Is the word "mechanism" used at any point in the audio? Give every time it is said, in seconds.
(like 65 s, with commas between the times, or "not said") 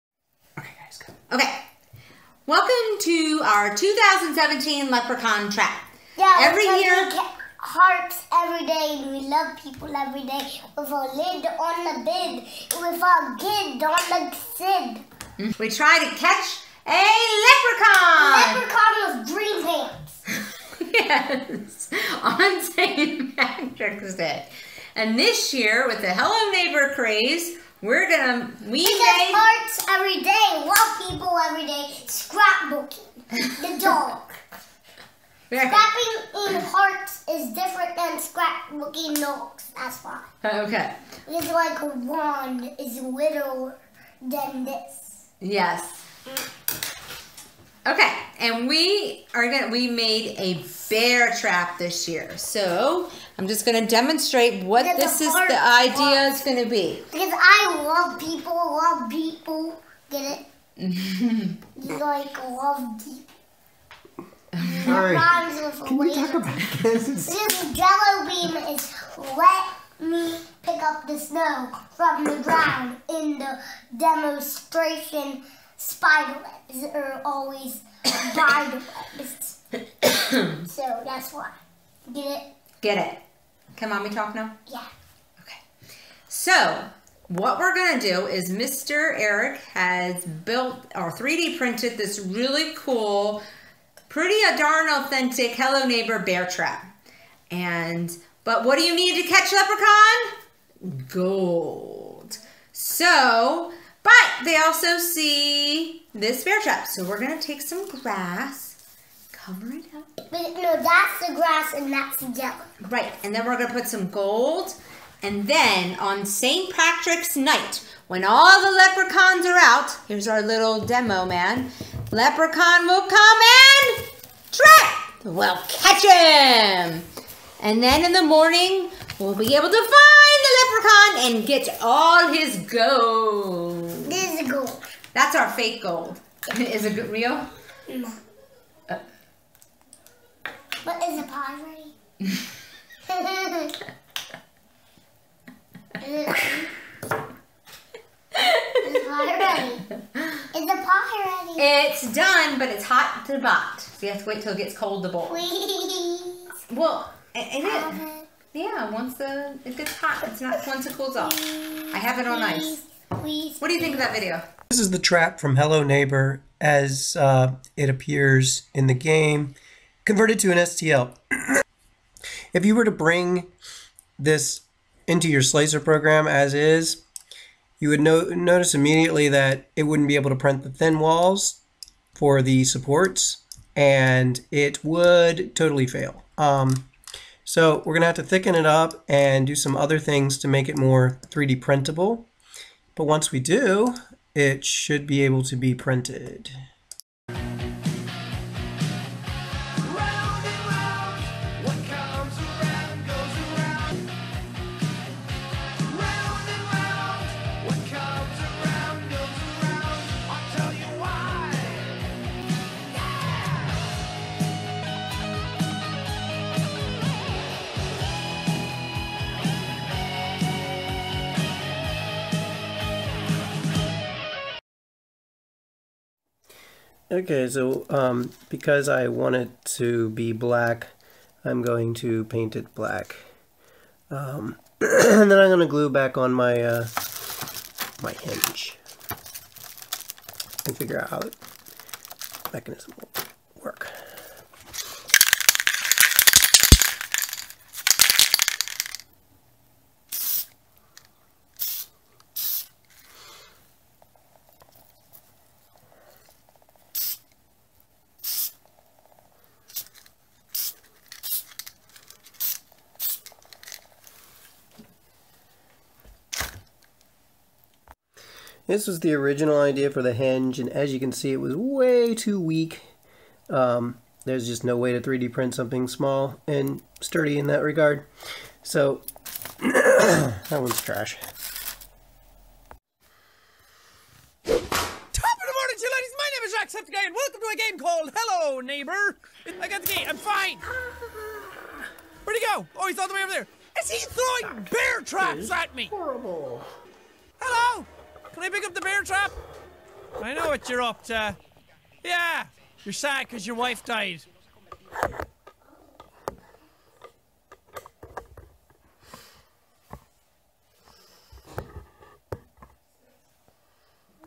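242 s.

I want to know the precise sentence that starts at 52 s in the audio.
So I'm just gonna demonstrate what this is the idea is gonna be.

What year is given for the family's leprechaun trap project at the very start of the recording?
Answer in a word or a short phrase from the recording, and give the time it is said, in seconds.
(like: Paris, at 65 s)
2017, at 3 s.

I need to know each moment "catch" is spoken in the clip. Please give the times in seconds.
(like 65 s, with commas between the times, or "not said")
16 s, 99 s, 125 s.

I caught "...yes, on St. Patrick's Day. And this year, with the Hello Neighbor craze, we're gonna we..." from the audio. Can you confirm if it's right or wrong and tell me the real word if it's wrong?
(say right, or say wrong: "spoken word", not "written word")
right.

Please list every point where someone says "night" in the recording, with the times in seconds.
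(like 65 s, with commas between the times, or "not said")
117 s.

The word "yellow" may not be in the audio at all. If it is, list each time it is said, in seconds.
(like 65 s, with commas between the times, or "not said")
112 s.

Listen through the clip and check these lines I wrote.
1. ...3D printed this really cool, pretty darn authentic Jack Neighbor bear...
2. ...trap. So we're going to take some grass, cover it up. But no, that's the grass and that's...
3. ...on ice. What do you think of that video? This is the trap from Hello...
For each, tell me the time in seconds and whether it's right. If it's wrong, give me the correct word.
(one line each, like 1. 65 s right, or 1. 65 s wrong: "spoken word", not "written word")
1. 91 s wrong: "Hello", not "Jack"
2. 106 s right
3. 162 s right.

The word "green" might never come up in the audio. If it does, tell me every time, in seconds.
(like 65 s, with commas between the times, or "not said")
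21 s.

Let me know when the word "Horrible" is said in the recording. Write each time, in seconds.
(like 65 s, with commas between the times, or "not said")
295 s.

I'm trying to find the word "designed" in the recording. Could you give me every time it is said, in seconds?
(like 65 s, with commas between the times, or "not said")
not said.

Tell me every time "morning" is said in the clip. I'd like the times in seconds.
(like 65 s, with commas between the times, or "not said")
128 s, 284 s.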